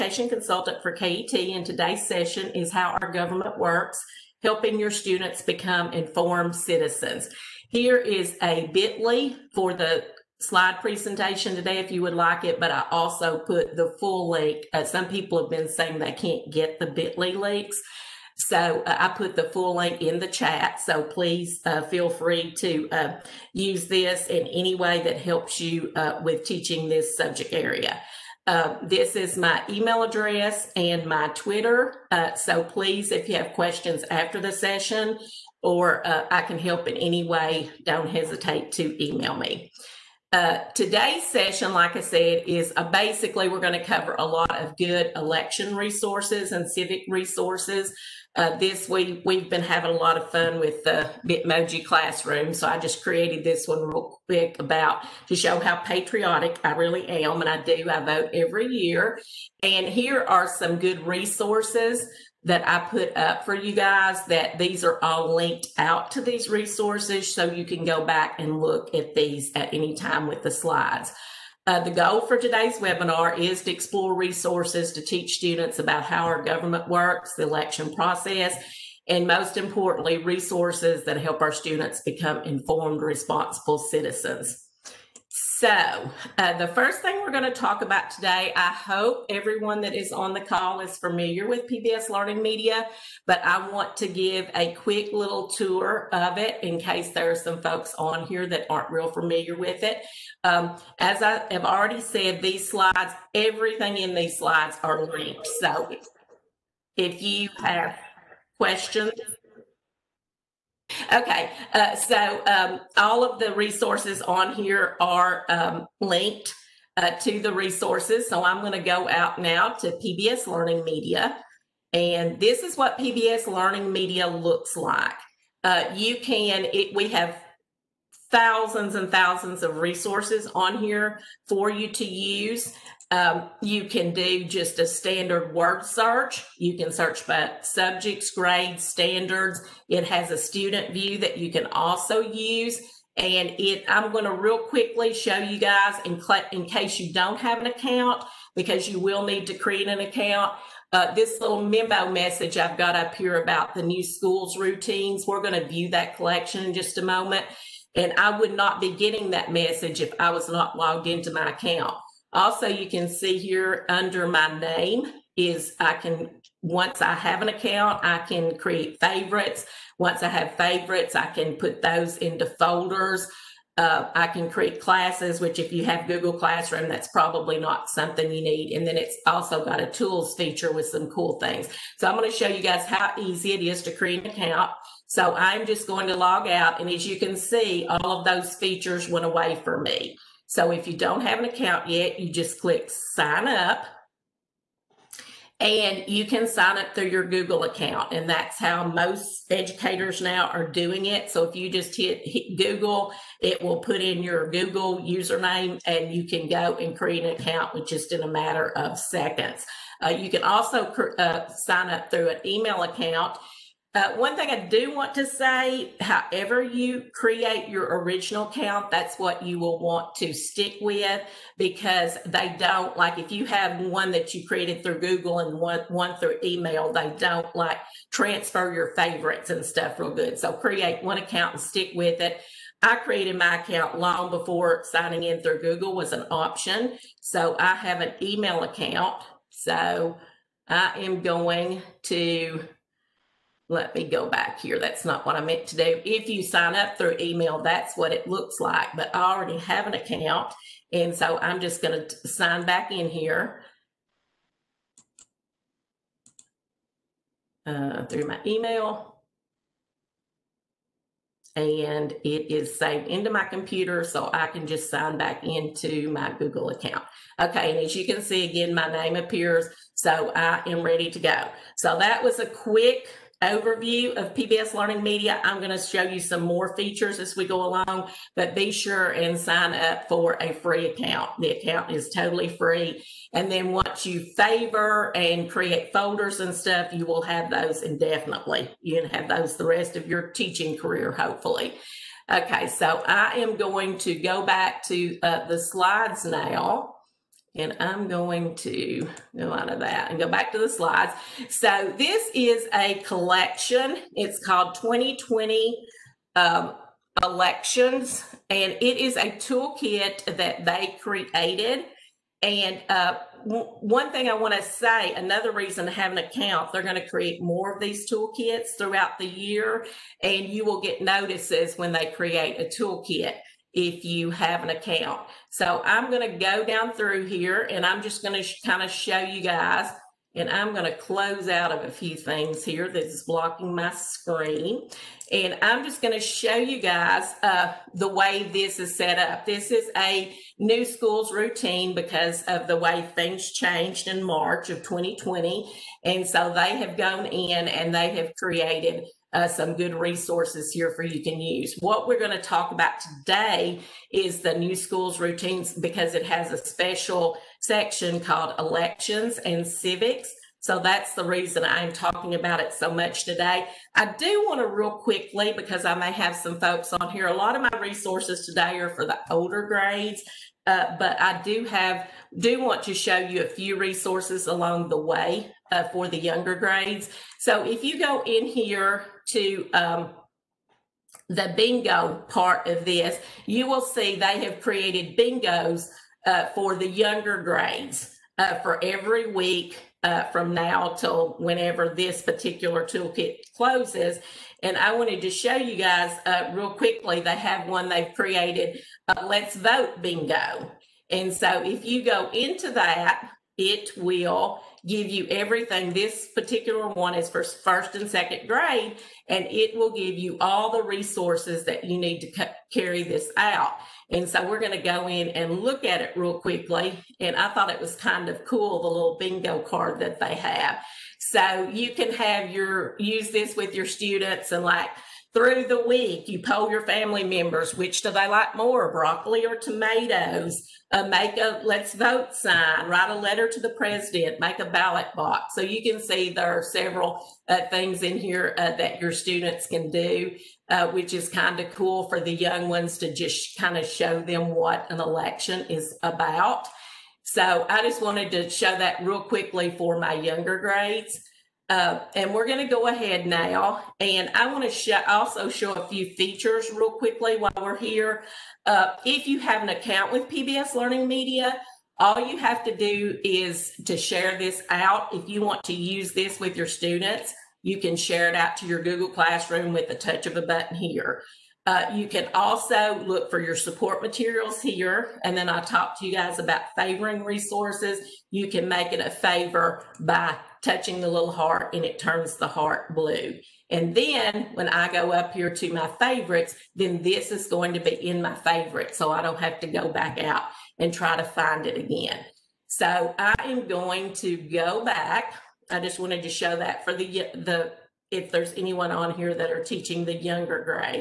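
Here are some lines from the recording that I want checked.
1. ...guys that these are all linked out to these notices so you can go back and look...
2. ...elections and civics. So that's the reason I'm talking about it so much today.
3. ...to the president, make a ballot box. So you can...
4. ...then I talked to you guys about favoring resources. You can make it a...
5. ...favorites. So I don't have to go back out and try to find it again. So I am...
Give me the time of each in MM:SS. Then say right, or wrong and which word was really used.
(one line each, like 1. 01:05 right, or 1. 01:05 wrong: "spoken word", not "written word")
1. 01:03 wrong: "resources", not "notices"
2. 05:58 right
3. 07:13 right
4. 07:55 right
5. 08:08 right.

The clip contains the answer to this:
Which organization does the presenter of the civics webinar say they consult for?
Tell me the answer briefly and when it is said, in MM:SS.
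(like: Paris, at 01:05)
KET, at 00:00.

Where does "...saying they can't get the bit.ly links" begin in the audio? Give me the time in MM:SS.
00:15.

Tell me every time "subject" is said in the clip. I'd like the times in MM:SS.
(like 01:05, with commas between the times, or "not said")
00:27, 02:17.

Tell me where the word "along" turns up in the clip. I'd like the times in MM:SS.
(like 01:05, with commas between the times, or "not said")
04:37, 06:14.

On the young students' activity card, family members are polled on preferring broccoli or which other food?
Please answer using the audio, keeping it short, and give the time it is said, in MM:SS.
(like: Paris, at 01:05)
tomatoes, at 07:09.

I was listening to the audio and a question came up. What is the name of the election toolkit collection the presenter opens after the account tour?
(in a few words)
2020 Elections.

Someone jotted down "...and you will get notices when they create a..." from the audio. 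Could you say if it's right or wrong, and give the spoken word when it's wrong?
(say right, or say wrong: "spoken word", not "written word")
right.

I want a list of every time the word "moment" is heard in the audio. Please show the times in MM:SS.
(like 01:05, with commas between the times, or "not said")
02:37.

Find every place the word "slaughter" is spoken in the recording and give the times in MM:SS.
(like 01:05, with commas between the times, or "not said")
not said.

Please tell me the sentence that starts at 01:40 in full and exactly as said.
Um, as I have already said, these slides, everything in these slides are linked.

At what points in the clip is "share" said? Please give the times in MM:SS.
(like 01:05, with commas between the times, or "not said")
07:43, 07:47.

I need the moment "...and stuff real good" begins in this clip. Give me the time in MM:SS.
03:49.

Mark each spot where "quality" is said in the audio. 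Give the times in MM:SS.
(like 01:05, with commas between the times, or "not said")
not said.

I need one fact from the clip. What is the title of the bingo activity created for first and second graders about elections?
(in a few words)
Let's Vote Bingo.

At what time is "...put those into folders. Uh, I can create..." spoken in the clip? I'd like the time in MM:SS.
02:51.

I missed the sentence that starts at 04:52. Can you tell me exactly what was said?
Okay, so I am going to go back to uh, the slides now.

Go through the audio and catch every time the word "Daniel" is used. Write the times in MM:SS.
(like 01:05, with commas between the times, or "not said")
not said.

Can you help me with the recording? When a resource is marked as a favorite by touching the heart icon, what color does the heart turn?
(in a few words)
blue.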